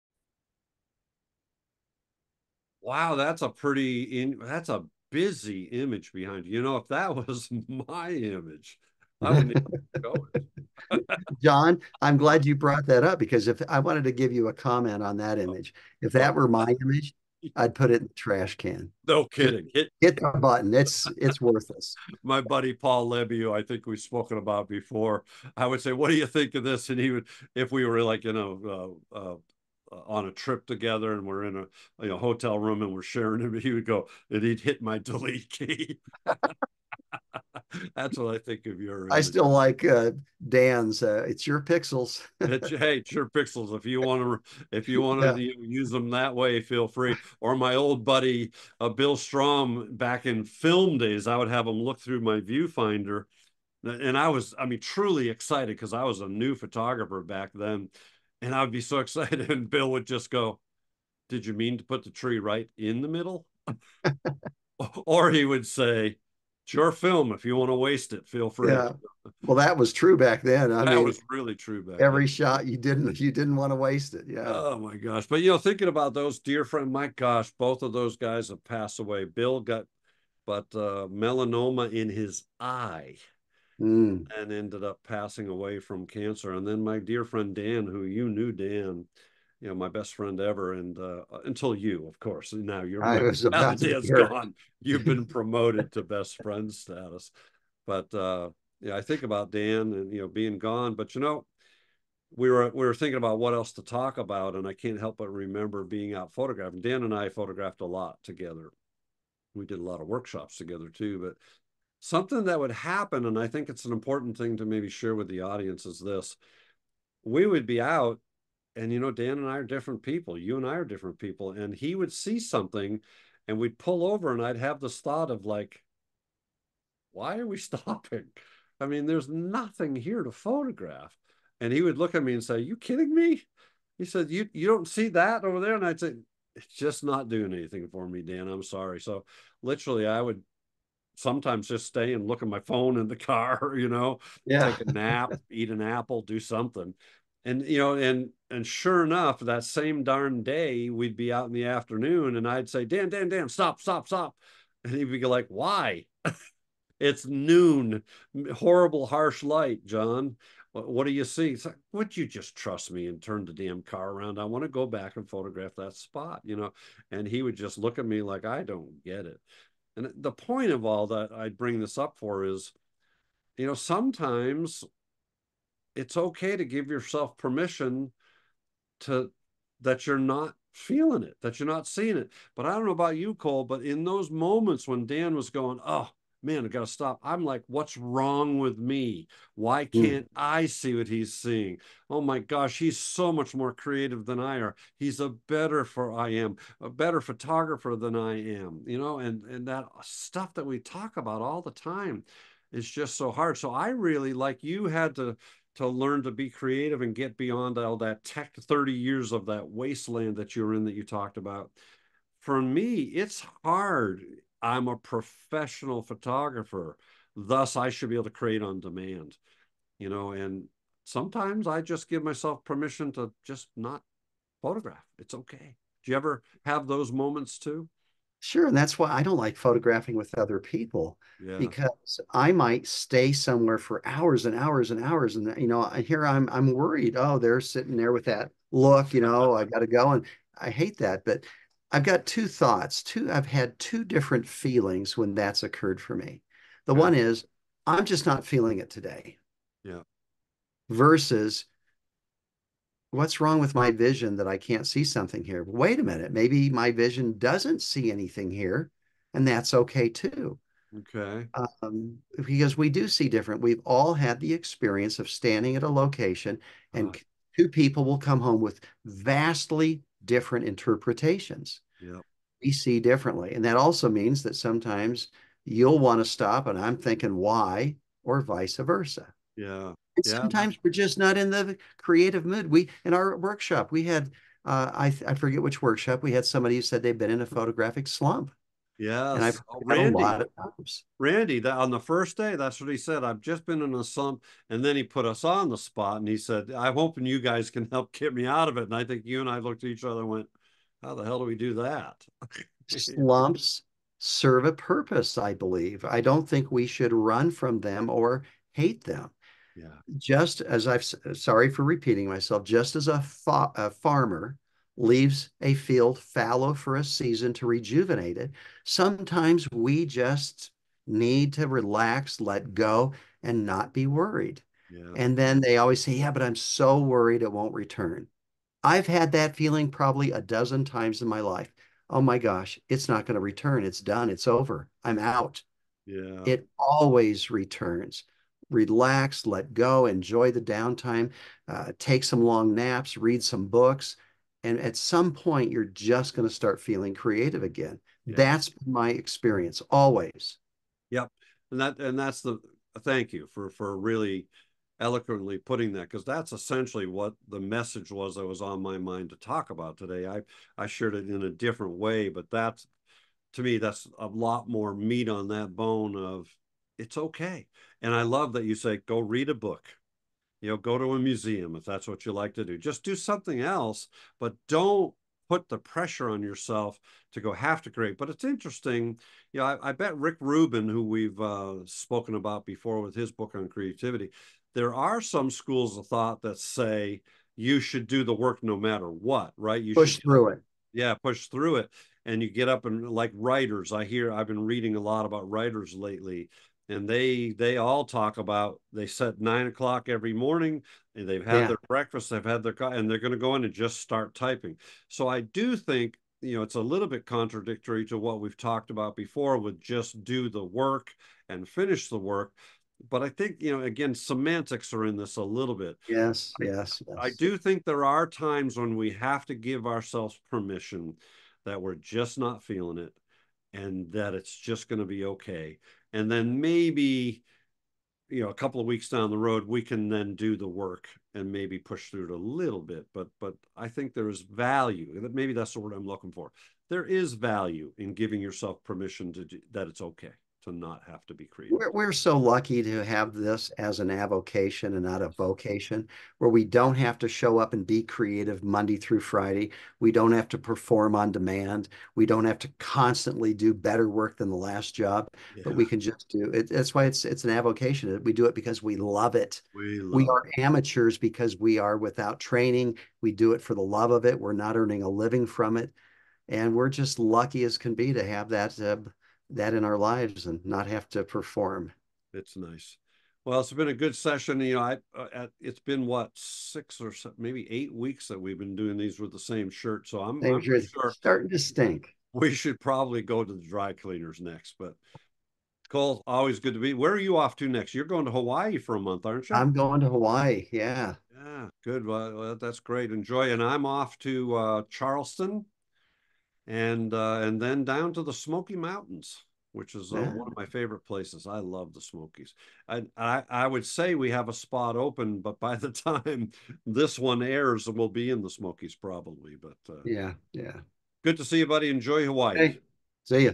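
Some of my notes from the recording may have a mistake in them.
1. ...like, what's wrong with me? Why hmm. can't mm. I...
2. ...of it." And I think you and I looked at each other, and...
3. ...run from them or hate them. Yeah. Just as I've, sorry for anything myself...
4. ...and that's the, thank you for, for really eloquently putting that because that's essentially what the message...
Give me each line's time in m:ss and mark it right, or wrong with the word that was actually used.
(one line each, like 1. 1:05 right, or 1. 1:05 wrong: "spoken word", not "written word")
1. 3:07 right
2. 4:58 right
3. 5:07 wrong: "repeating", not "anything"
4. 5:51 right.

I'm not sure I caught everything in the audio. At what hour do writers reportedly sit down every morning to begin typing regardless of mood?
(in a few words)
9 o'clock.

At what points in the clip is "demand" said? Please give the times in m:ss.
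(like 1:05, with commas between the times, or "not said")
3:38, 7:31.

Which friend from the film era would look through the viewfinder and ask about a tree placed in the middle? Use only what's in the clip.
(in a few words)
Bill Strom.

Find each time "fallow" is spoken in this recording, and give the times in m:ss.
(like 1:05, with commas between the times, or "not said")
5:16.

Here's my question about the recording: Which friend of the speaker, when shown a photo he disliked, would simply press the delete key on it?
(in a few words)
Paul Levy.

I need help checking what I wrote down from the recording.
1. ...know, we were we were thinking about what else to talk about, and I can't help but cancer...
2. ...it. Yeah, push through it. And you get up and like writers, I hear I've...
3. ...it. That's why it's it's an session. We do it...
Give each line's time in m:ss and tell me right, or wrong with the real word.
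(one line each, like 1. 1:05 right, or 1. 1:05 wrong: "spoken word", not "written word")
1. 1:41 wrong: "remember", not "cancer"
2. 6:30 right
3. 7:36 wrong: "avocation", not "session".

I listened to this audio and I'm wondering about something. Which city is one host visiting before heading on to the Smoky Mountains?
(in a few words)
Charleston.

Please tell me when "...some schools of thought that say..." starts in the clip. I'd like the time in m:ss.
6:25.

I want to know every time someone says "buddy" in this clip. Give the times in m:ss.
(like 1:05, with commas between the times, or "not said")
0:22, 0:48, 8:31.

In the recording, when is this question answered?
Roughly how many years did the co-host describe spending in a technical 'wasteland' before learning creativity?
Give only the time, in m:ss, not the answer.
3:28.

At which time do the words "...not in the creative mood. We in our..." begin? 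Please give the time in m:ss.
4:41.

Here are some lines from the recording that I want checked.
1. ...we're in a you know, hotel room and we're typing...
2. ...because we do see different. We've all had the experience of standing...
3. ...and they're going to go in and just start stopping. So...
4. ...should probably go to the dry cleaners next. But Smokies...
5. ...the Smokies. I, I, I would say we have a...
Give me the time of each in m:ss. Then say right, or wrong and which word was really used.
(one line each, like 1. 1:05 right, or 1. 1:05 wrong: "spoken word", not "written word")
1. 0:31 wrong: "sharing", not "typing"
2. 4:22 right
3. 6:42 wrong: "typing", not "stopping"
4. 8:02 wrong: "Cole", not "Smokies"
5. 8:21 right.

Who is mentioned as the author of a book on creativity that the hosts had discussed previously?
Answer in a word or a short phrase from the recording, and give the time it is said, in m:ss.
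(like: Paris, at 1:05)
Rick Rubin, at 6:20.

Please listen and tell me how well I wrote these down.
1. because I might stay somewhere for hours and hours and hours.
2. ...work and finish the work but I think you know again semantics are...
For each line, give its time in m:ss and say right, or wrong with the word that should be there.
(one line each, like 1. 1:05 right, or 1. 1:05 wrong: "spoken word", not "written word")
1. 3:51 right
2. 6:50 right.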